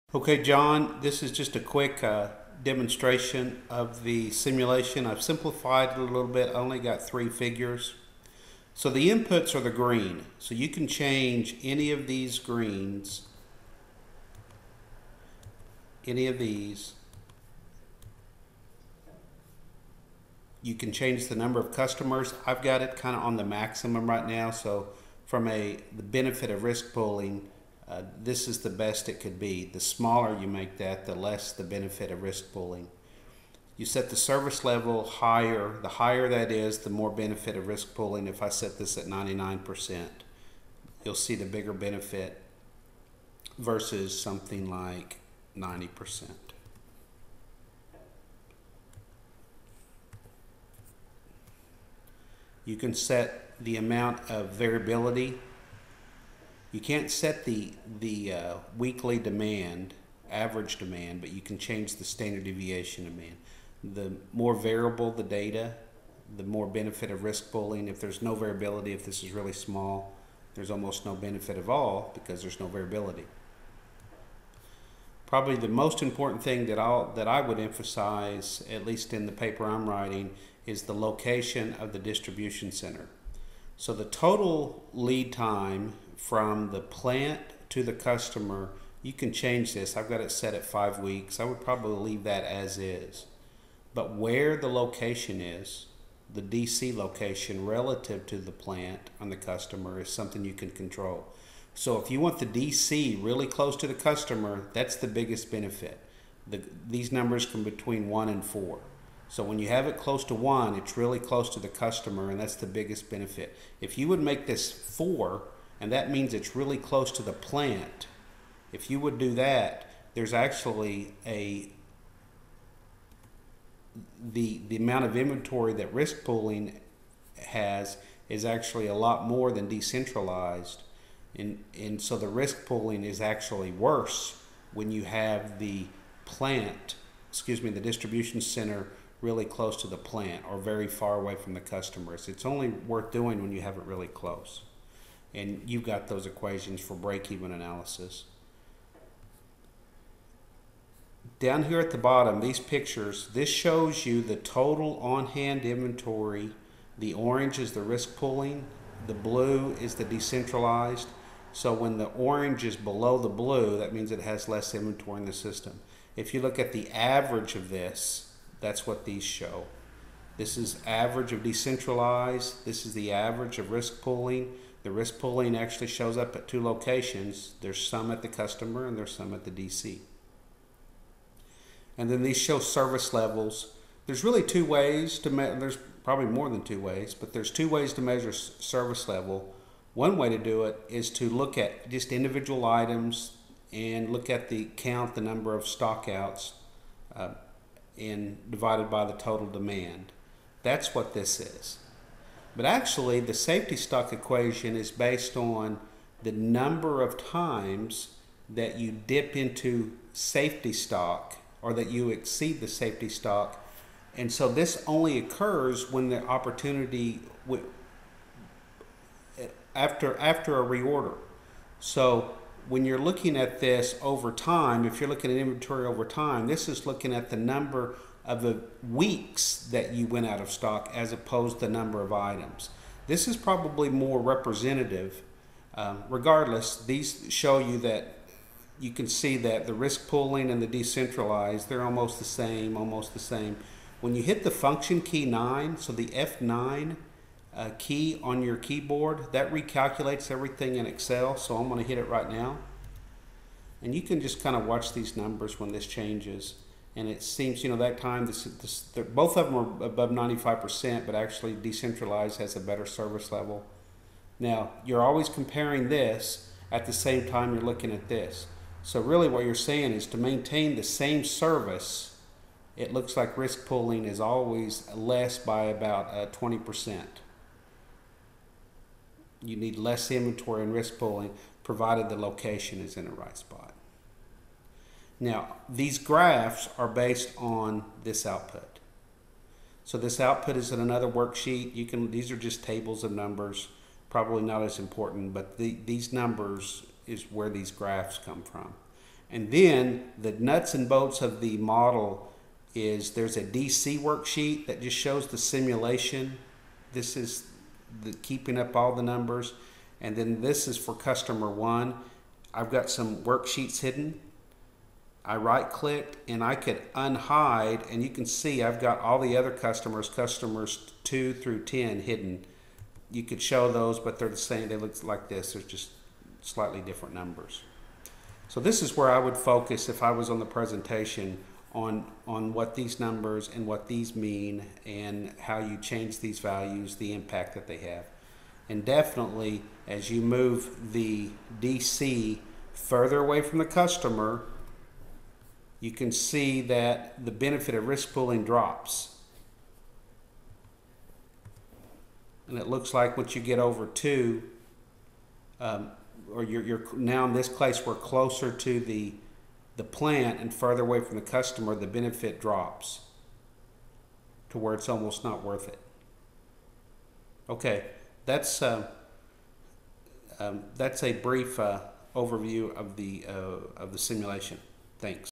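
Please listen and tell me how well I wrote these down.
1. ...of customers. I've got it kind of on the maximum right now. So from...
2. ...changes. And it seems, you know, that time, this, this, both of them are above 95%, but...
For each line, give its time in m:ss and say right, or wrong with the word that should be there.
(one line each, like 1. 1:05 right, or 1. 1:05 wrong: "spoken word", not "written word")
1. 0:21 right
2. 4:15 right.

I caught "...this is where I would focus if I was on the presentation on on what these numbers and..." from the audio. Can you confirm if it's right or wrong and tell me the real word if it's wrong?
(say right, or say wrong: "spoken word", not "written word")
right.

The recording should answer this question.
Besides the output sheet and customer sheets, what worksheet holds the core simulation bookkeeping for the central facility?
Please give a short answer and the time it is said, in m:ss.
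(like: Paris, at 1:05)
DC worksheet, at 5:03.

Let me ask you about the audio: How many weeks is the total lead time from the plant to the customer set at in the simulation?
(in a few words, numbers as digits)
5.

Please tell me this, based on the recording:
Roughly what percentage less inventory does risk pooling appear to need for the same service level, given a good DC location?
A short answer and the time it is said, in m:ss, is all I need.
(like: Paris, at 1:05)
20%, at 4:36.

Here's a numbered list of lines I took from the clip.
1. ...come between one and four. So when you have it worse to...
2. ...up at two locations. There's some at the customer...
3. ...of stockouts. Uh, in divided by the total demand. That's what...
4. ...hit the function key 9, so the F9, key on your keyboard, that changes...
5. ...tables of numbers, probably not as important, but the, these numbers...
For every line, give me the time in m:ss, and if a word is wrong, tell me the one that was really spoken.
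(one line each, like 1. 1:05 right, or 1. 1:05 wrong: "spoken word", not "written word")
1. 1:47 wrong: "close", not "worse"
2. 2:56 right
3. 3:15 right
4. 4:04 wrong: "recalculates", not "changes"
5. 4:52 right.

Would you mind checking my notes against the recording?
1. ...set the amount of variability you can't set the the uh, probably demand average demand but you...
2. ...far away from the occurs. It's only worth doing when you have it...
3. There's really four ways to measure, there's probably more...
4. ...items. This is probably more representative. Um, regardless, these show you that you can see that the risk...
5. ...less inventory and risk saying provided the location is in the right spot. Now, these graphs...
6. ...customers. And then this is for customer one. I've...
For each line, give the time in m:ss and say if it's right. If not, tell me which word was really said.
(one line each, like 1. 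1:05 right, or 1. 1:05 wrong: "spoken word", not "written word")
1. 0:52 wrong: "weekly", not "probably"
2. 2:20 wrong: "customers", not "occurs"
3. 3:04 wrong: "two", not "four"
4. 3:52 right
5. 4:39 wrong: "pooling", not "saying"
6. 5:09 wrong: "numbers", not "customers".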